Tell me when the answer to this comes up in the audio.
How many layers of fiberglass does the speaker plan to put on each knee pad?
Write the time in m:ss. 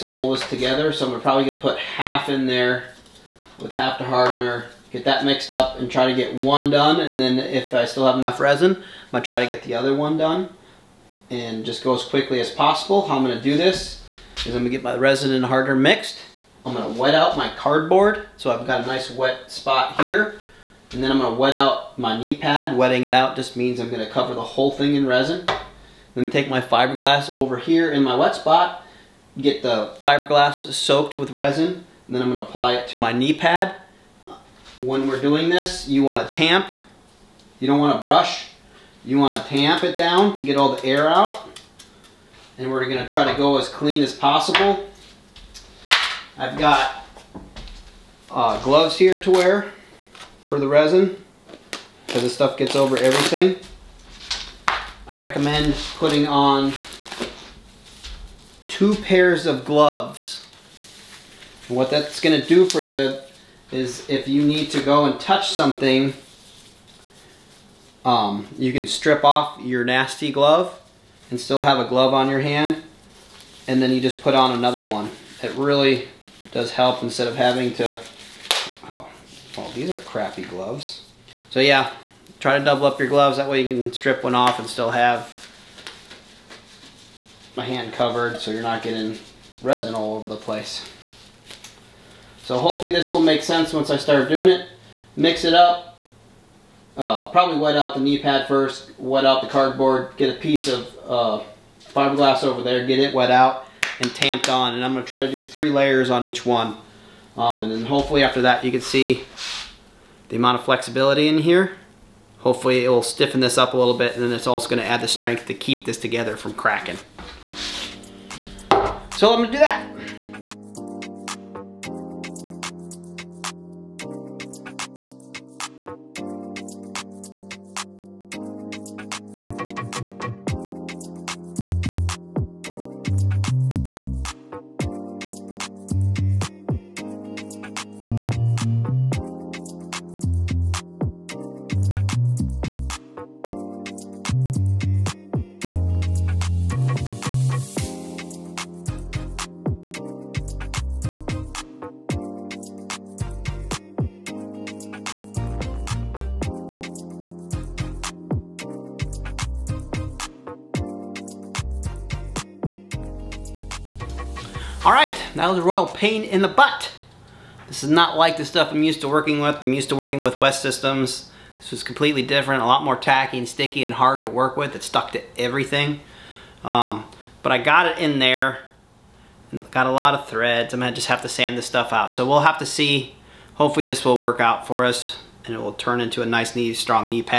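1:45.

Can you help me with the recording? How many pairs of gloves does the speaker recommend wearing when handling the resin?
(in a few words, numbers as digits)
2.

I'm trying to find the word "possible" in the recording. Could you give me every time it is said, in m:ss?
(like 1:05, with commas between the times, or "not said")
0:12, 0:44.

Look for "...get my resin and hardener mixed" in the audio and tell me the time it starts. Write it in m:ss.
0:14.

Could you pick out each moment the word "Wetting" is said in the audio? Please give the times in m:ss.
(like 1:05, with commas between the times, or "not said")
0:22.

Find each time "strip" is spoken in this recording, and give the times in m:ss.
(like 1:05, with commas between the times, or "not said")
1:08, 1:23.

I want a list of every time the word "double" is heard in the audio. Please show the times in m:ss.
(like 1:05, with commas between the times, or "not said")
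1:22.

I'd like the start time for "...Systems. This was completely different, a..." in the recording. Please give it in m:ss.
2:50.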